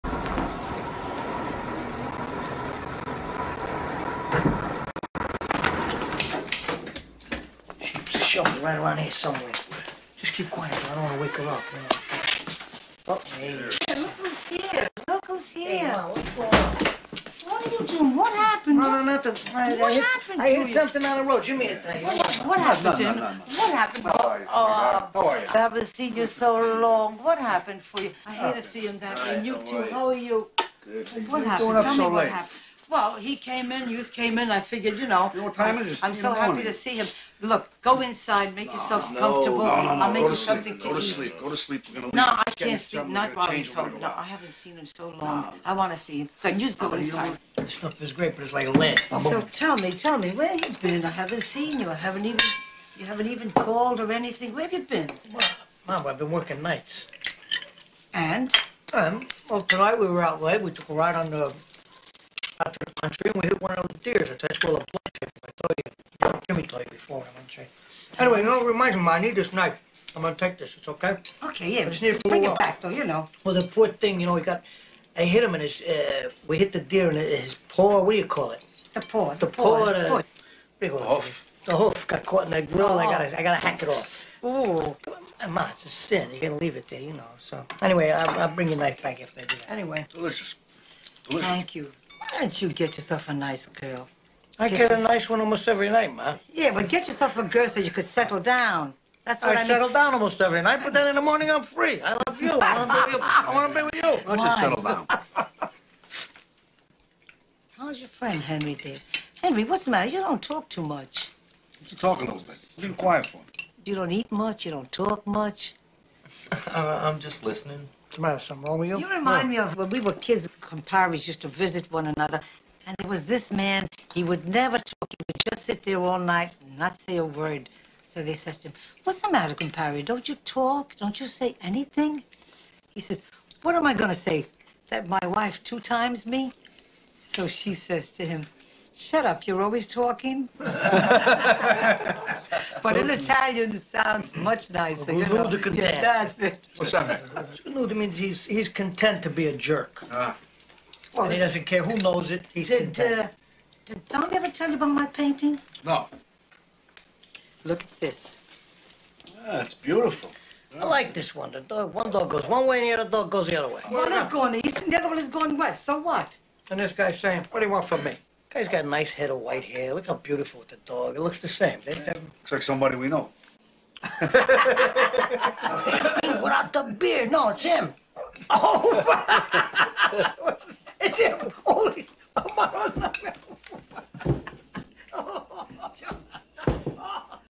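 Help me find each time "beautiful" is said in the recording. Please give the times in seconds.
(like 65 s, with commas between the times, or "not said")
159 s, 170 s.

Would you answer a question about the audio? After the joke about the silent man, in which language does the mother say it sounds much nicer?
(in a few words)
Italian.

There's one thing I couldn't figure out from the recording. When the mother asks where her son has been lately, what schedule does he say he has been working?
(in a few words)
nights.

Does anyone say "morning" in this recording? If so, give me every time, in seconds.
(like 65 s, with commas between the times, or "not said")
36 s, 101 s.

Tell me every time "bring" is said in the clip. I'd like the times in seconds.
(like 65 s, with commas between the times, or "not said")
72 s, 88 s.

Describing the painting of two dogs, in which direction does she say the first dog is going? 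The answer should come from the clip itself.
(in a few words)
east.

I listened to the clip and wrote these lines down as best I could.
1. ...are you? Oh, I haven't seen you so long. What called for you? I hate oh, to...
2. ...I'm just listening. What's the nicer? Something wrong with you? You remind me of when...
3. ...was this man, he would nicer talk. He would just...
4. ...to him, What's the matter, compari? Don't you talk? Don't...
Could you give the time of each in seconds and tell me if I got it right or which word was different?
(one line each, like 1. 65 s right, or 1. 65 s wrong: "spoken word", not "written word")
1. 25 s wrong: "happened", not "called"
2. 116 s wrong: "matter", not "nicer"
3. 123 s wrong: "never", not "nicer"
4. 128 s right.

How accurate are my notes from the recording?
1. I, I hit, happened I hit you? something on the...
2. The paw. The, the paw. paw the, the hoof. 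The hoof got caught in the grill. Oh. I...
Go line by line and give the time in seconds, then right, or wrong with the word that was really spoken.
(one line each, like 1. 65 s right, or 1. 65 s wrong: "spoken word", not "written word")
1. 19 s right
2. 78 s right.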